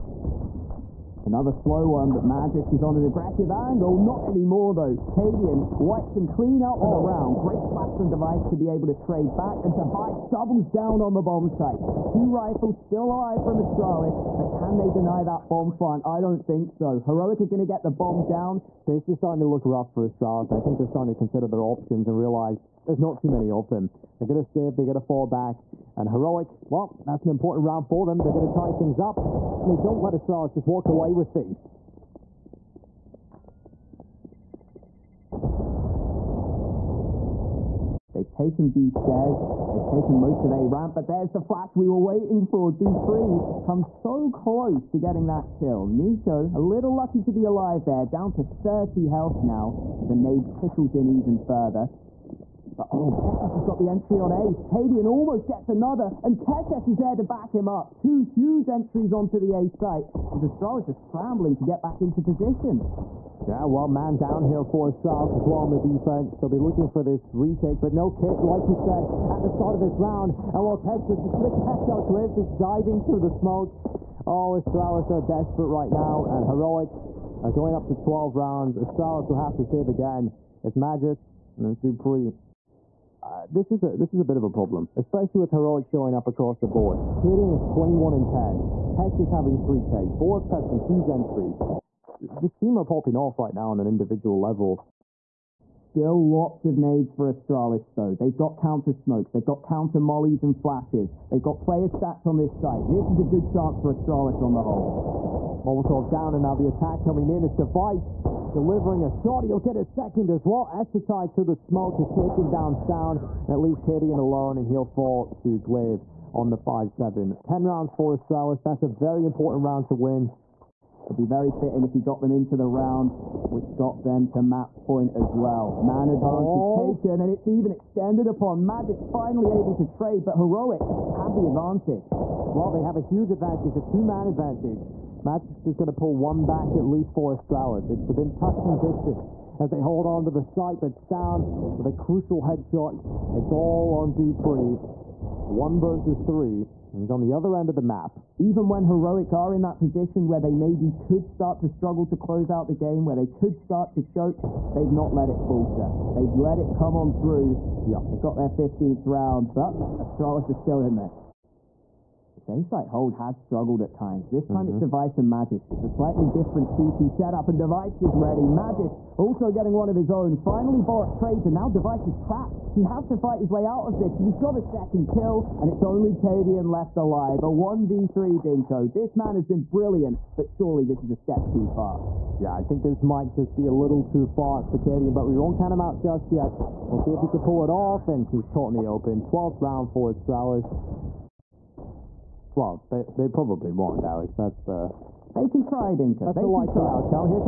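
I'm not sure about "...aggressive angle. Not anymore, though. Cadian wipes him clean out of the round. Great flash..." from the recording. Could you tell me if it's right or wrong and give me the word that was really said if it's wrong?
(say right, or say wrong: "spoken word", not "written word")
right.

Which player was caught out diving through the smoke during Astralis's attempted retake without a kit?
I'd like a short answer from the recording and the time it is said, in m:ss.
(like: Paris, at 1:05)
Cliff, at 1:12.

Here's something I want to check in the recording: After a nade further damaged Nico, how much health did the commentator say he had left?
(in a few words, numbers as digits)
30.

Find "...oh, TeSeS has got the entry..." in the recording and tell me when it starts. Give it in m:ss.
0:52.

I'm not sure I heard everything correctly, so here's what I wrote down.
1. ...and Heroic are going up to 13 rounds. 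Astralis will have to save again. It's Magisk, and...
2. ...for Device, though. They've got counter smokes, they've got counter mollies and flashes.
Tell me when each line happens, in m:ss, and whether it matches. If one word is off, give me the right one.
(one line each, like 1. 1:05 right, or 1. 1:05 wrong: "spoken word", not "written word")
1. 1:16 wrong: "12", not "13"
2. 1:37 wrong: "Astralis", not "Device".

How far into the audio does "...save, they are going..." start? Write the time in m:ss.
0:24.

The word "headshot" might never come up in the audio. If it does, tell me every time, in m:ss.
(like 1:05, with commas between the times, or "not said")
2:22.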